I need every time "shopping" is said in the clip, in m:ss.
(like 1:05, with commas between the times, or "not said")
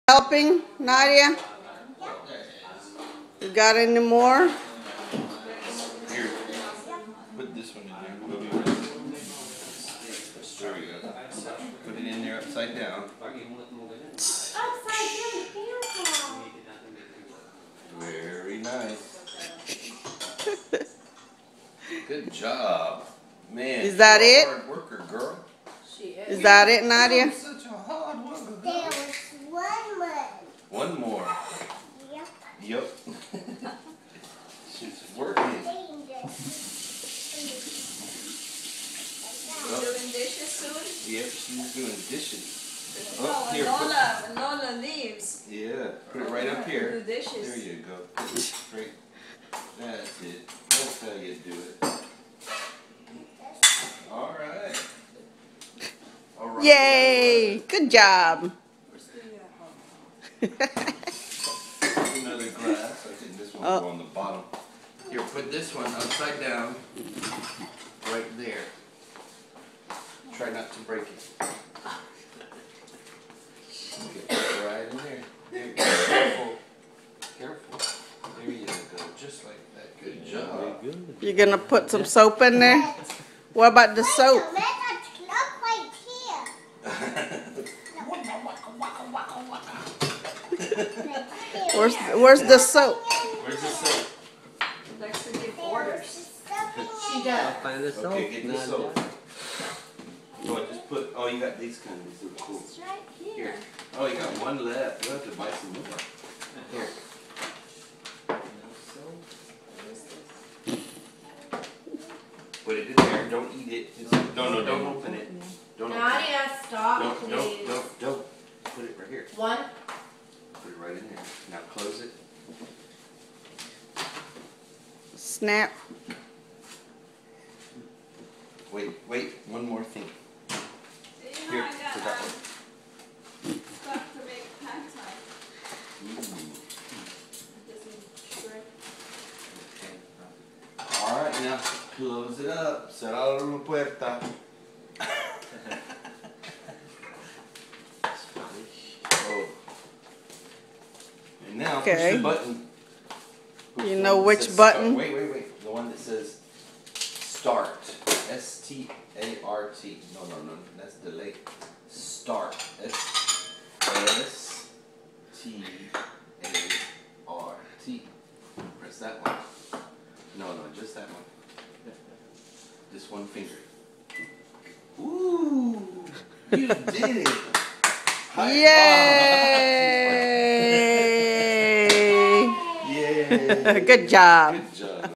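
0:00.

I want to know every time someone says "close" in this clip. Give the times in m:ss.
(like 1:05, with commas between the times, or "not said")
2:01, 2:21.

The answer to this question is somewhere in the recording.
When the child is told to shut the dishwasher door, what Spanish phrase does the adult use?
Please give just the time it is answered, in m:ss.
2:22.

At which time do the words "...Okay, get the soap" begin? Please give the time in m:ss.
1:38.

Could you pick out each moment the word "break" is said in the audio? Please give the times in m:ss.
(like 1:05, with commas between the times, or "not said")
1:10.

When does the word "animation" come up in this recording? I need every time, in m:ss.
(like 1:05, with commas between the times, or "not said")
not said.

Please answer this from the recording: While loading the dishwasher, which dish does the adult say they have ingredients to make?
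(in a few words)
pad thai.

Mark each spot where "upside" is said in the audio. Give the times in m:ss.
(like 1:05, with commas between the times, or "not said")
0:12, 1:05.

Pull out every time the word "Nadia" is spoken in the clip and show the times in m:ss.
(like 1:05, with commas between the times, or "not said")
0:00, 0:26, 1:55.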